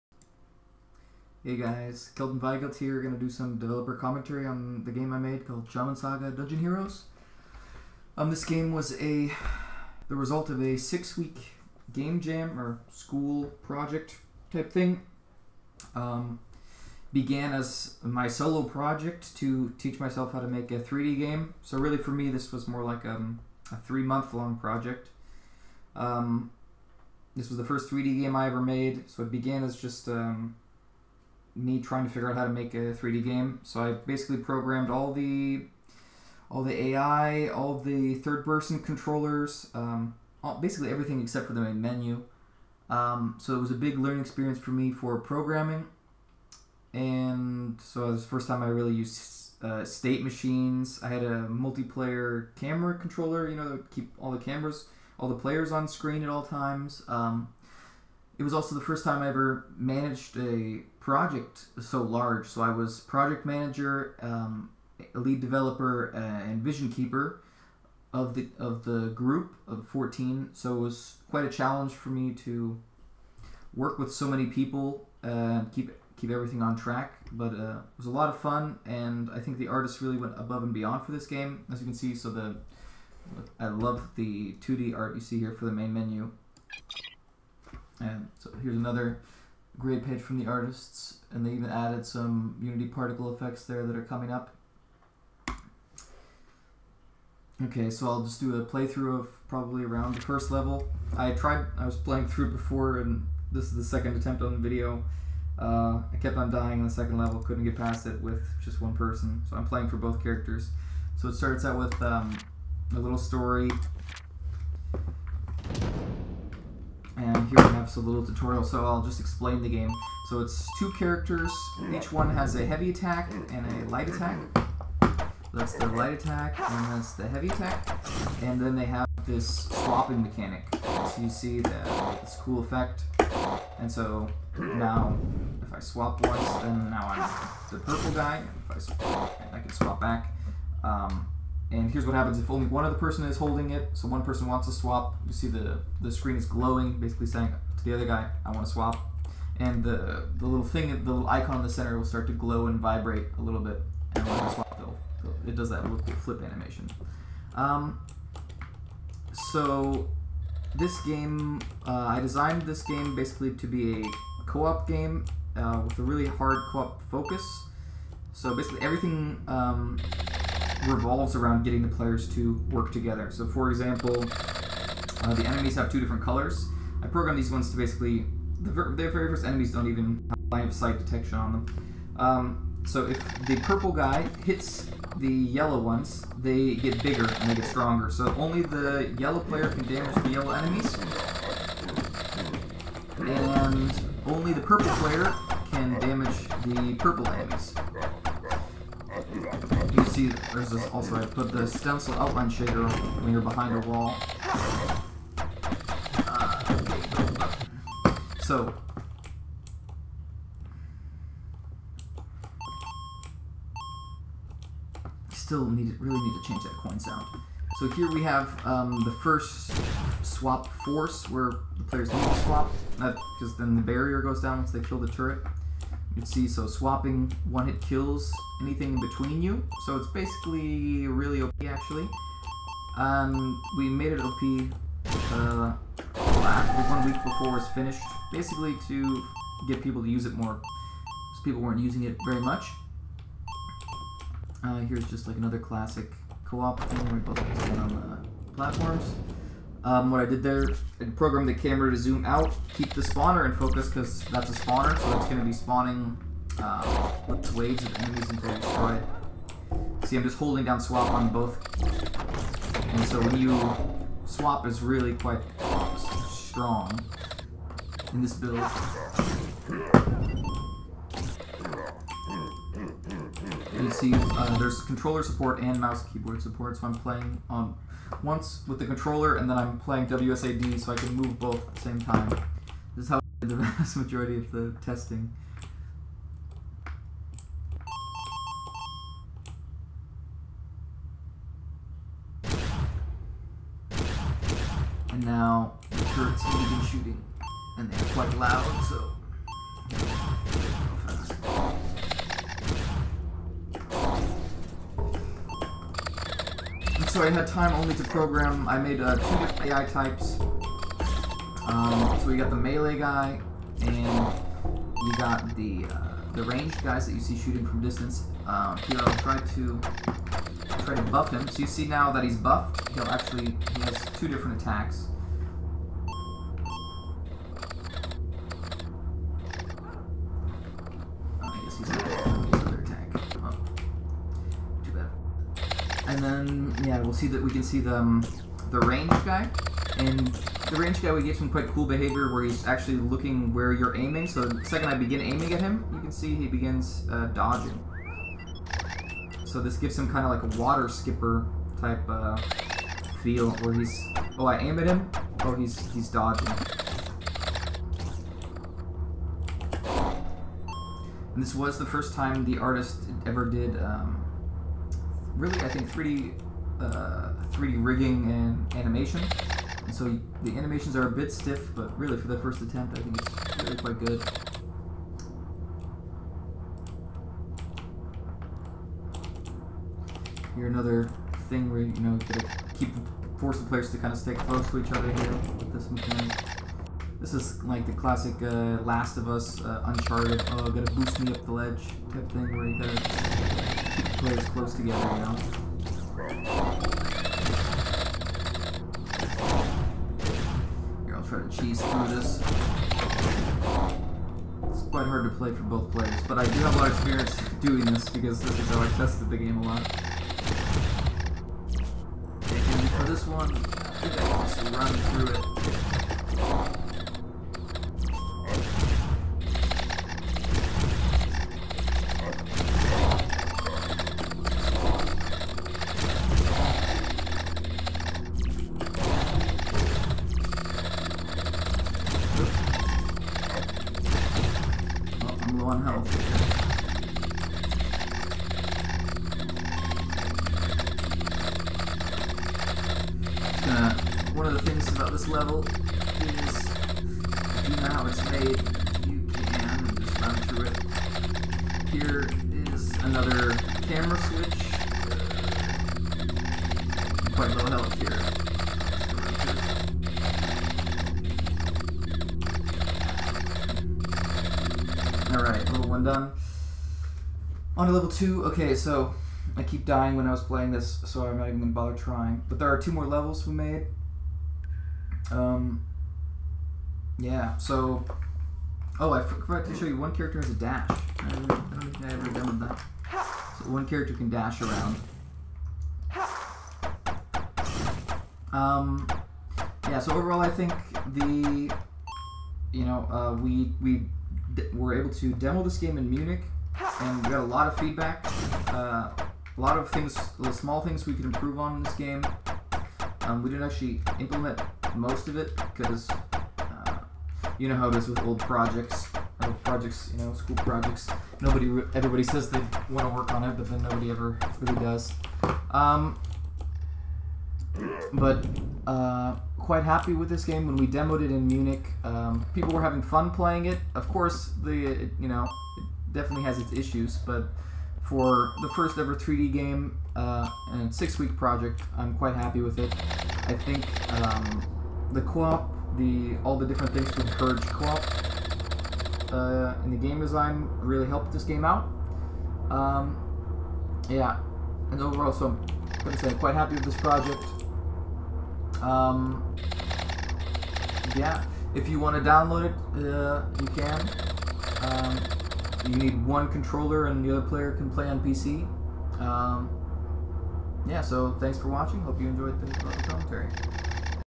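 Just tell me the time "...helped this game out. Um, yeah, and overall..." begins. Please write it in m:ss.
9:01.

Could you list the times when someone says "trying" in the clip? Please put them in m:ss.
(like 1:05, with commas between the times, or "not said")
0:31, 7:51.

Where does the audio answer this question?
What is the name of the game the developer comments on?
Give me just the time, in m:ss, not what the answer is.
0:05.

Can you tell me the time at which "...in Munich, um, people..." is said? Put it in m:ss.
8:41.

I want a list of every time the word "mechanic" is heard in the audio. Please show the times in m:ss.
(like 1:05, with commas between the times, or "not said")
2:10, 6:25.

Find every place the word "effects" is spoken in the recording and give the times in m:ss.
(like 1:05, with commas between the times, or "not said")
1:33, 2:12.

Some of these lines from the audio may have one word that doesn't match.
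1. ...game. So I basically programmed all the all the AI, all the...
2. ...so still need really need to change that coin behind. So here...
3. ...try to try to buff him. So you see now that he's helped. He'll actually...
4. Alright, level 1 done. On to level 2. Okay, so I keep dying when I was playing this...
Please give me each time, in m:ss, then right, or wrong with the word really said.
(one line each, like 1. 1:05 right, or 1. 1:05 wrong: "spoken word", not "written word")
1. 0:33 right
2. 3:28 wrong: "sound", not "behind"
3. 5:19 wrong: "buffed", not "helped"
4. 7:45 right.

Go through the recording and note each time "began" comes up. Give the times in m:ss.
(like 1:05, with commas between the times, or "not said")
0:17, 0:29.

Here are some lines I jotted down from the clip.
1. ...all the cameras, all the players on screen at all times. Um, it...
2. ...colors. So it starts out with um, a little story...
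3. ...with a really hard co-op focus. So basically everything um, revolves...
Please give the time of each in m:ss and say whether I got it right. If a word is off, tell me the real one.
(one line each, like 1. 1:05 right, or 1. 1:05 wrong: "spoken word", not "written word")
1. 0:54 right
2. 1:50 wrong: "characters", not "colors"
3. 2:45 right.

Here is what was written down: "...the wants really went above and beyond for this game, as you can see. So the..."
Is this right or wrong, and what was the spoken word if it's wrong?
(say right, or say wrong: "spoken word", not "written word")
wrong: "artists", not "wants".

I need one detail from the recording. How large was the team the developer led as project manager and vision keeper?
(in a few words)
14.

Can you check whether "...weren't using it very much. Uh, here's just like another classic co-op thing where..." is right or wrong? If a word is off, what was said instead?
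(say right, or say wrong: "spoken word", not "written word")
right.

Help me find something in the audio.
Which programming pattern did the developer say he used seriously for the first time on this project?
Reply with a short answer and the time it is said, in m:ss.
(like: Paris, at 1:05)
State machines, at 0:49.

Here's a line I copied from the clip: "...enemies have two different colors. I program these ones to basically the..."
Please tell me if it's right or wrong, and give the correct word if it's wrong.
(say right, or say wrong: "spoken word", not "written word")
right.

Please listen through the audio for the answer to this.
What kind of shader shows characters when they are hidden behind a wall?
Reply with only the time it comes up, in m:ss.
3:21.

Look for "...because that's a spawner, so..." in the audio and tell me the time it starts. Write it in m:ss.
4:13.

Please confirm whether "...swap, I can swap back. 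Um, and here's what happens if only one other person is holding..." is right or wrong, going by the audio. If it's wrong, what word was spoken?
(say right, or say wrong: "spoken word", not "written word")
right.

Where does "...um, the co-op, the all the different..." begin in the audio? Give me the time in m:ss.
8:54.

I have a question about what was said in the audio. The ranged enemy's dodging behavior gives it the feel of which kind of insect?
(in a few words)
Water skipper.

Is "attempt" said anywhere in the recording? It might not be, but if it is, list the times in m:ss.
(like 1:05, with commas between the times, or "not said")
1:44, 6:12.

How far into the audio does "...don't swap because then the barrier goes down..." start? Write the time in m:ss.
3:42.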